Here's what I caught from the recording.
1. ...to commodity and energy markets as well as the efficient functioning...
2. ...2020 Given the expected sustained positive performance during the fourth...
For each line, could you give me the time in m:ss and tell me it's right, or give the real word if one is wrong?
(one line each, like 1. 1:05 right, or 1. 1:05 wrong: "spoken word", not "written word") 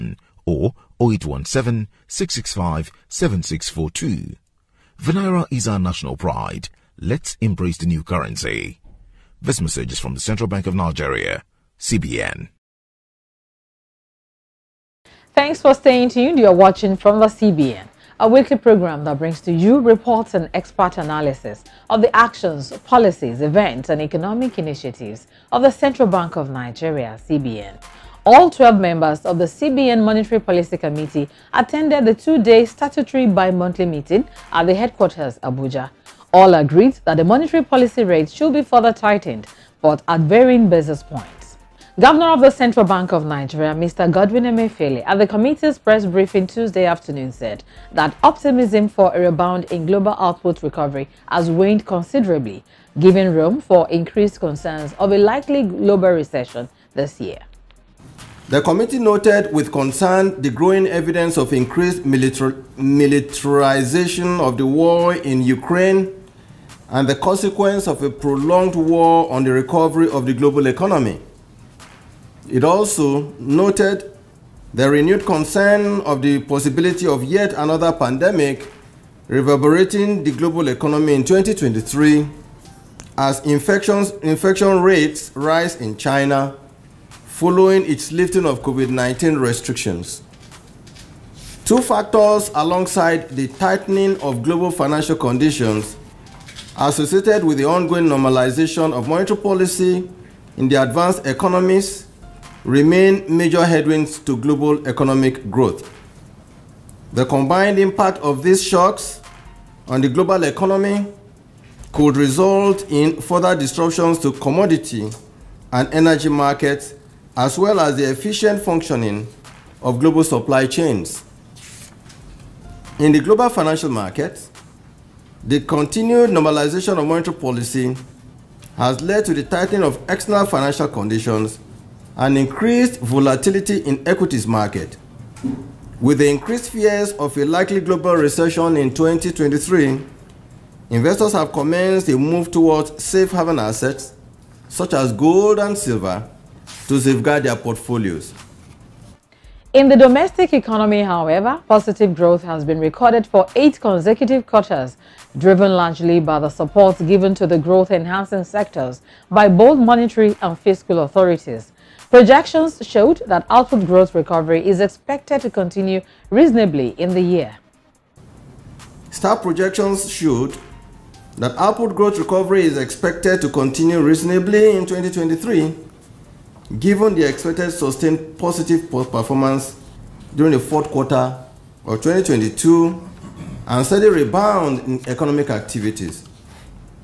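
1. 1:54 right
2. 2:54 wrong: "2023", not "2020".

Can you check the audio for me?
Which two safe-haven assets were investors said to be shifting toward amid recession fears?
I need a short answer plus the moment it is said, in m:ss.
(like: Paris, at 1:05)
Gold and silver, at 2:25.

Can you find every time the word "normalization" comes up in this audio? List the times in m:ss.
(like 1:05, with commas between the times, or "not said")
1:38, 2:06.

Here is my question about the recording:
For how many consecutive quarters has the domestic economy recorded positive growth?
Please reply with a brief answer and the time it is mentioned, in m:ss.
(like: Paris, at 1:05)
8, at 2:33.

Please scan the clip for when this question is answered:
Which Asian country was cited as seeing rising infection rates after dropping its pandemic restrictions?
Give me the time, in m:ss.
1:25.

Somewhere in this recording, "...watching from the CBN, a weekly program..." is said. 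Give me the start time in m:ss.
0:16.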